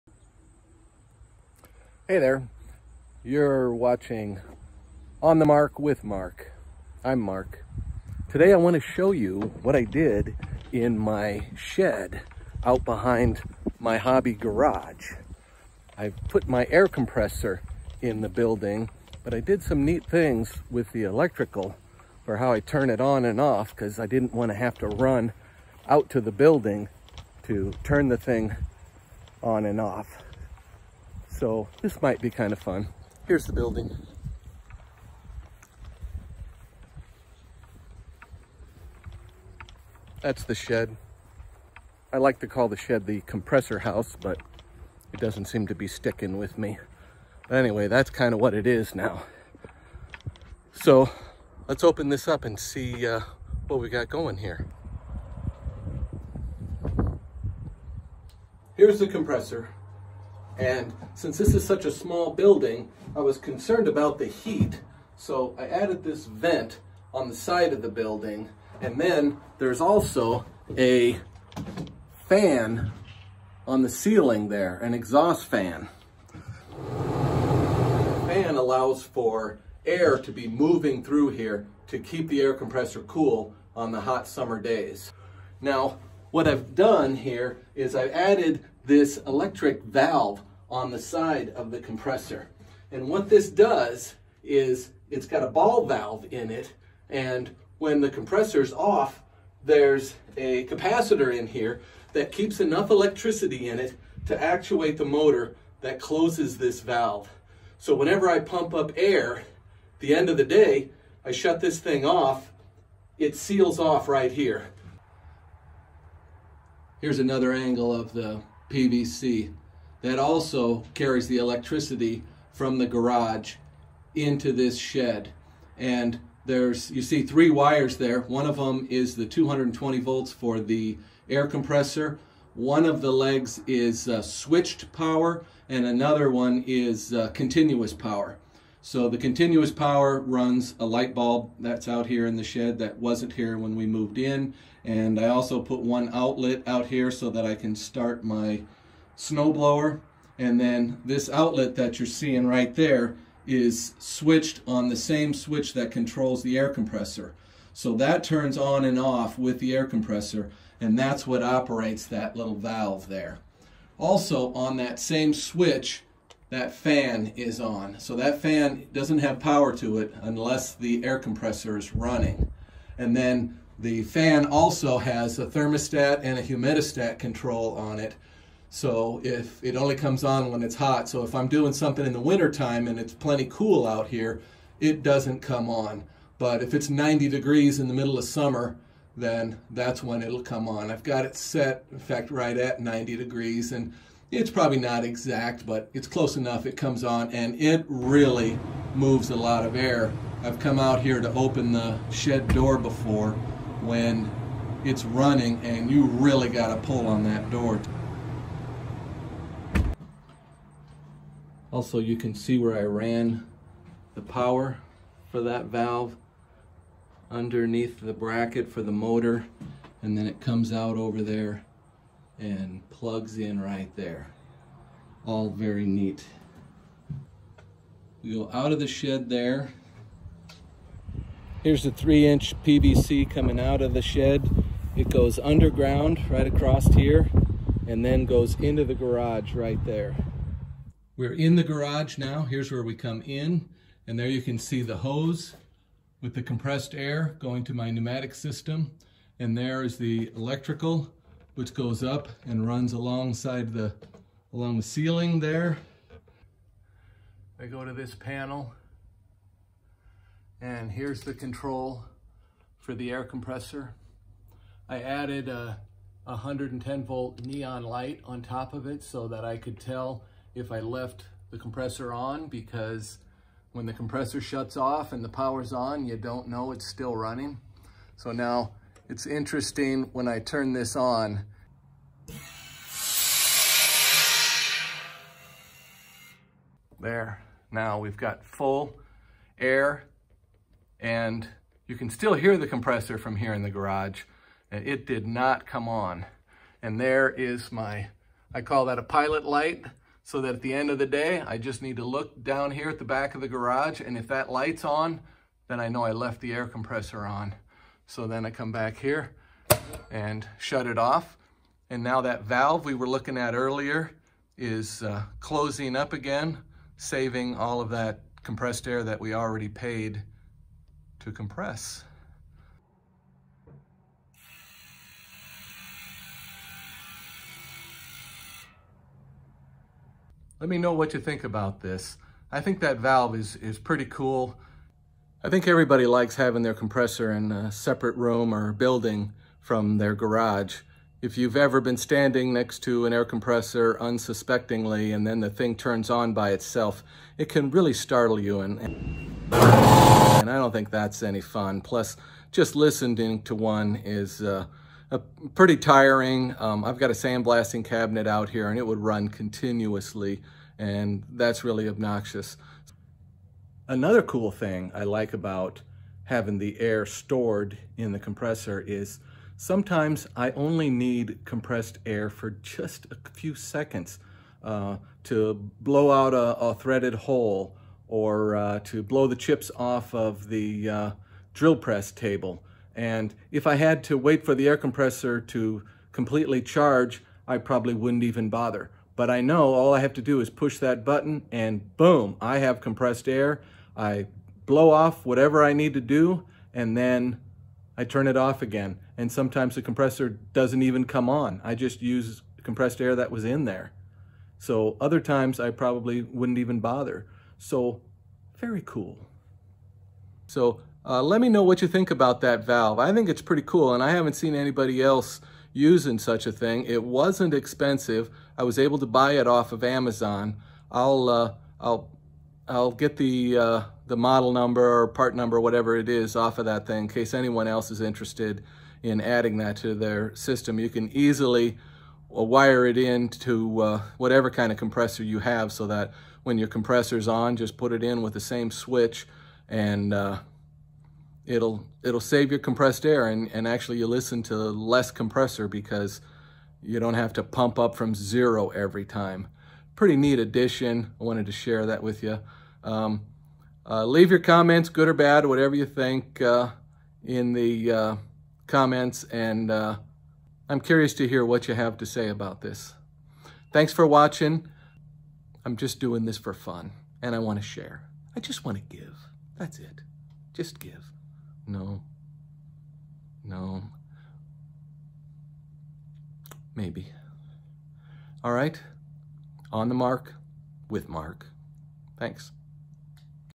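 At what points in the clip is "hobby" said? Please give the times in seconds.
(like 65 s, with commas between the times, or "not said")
13 s.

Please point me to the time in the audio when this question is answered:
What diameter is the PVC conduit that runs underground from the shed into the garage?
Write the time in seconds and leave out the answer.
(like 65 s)
231 s.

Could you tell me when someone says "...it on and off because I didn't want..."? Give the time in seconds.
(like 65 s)
22 s.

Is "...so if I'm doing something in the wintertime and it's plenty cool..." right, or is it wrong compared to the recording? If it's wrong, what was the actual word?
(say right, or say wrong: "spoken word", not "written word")
right.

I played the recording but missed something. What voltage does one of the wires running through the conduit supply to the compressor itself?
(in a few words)
220 volts.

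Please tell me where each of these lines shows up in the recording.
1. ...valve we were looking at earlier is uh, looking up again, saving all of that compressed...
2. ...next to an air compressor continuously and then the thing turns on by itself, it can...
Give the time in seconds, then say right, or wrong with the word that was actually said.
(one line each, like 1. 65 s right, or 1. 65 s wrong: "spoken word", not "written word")
1. 312 s wrong: "closing", not "looking"
2. 342 s wrong: "unsuspectingly", not "continuously".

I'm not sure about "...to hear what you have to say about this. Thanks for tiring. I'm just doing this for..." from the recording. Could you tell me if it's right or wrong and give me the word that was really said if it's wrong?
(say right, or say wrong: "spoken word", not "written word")
wrong: "watching", not "tiring".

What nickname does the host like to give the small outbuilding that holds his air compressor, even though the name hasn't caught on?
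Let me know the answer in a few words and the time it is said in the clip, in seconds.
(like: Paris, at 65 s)
the compressor house, at 43 s.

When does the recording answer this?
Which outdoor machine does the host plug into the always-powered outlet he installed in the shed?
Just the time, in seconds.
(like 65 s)
149 s.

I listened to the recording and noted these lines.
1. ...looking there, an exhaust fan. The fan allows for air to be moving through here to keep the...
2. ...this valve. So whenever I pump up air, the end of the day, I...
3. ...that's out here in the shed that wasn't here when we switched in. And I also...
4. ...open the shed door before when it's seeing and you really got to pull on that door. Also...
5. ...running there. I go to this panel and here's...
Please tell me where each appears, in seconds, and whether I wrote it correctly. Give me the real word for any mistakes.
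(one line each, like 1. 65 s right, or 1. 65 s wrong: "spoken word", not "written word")
1. 73 s wrong: "ceiling", not "looking"
2. 106 s right
3. 141 s wrong: "moved", not "switched"
4. 201 s wrong: "running", not "seeing"
5. 254 s wrong: "ceiling", not "running".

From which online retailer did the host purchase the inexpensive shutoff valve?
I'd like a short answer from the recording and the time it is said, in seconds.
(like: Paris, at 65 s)
Amazon, at 419 s.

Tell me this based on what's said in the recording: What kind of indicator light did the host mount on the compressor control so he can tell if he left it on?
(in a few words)
110 volt neon light.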